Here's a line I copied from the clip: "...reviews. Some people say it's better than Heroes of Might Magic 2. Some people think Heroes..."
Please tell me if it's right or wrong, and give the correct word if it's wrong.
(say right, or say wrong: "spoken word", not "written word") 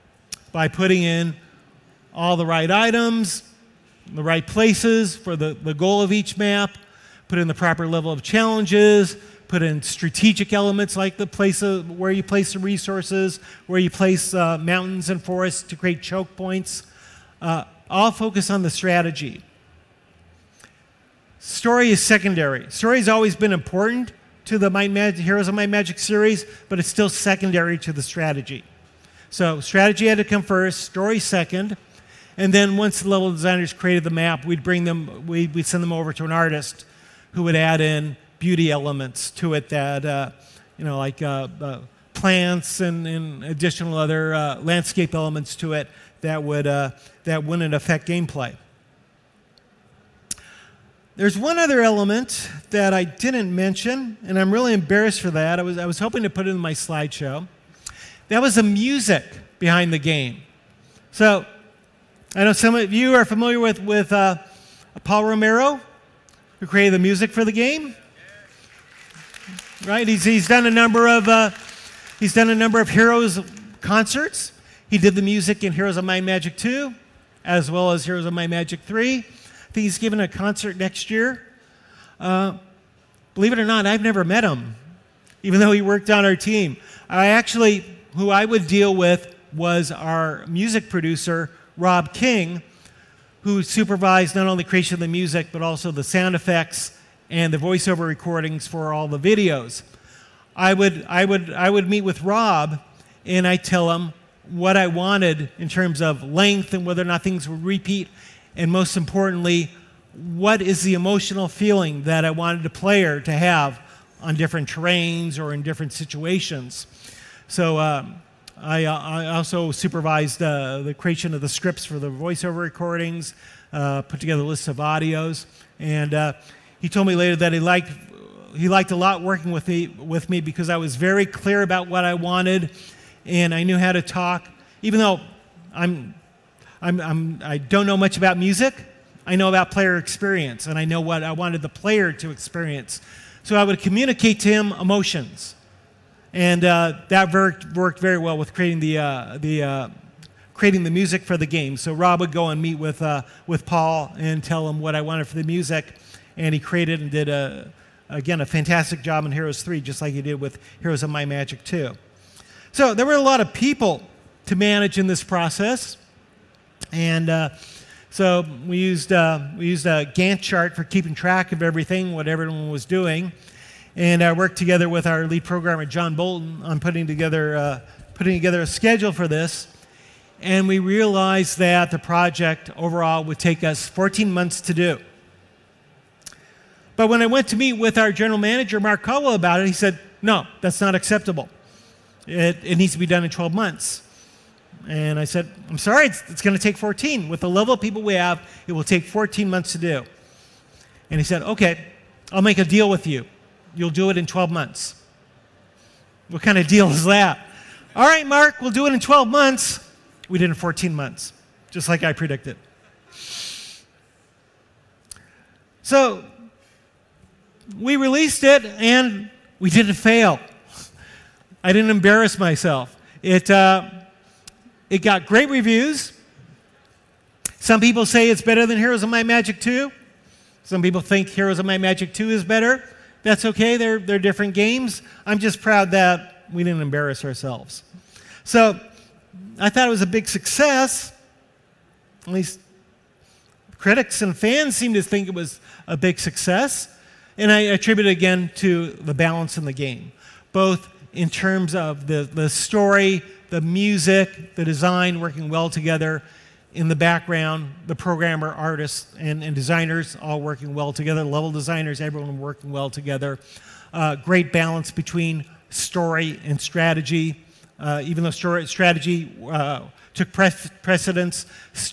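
right.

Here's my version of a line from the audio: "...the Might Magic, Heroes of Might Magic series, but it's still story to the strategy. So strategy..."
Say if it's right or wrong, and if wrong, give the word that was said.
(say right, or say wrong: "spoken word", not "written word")
wrong: "secondary", not "story".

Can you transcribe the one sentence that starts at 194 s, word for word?
And I said, I'm sorry, it's, it's going to take 14.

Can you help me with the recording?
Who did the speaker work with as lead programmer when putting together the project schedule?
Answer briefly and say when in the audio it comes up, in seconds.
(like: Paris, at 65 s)
John Bolton, at 175 s.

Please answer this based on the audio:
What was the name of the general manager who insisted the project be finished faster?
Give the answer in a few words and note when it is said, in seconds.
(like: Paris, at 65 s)
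Mark Caldwell, at 188 s.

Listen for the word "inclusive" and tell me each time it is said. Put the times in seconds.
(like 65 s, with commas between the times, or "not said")
not said.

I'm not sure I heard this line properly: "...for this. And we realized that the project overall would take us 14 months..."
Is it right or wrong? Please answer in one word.
right.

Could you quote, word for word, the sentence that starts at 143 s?
So I would communicate to him emotions.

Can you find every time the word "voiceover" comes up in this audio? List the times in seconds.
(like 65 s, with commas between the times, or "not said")
97 s, 122 s.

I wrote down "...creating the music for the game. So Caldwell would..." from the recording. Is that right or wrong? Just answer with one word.
wrong.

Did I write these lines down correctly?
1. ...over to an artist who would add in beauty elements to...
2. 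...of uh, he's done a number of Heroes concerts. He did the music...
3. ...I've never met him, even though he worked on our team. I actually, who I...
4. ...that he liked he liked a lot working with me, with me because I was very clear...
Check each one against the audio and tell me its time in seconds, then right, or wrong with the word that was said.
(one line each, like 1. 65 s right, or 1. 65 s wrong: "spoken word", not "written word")
1. 35 s right
2. 71 s right
3. 83 s right
4. 127 s right.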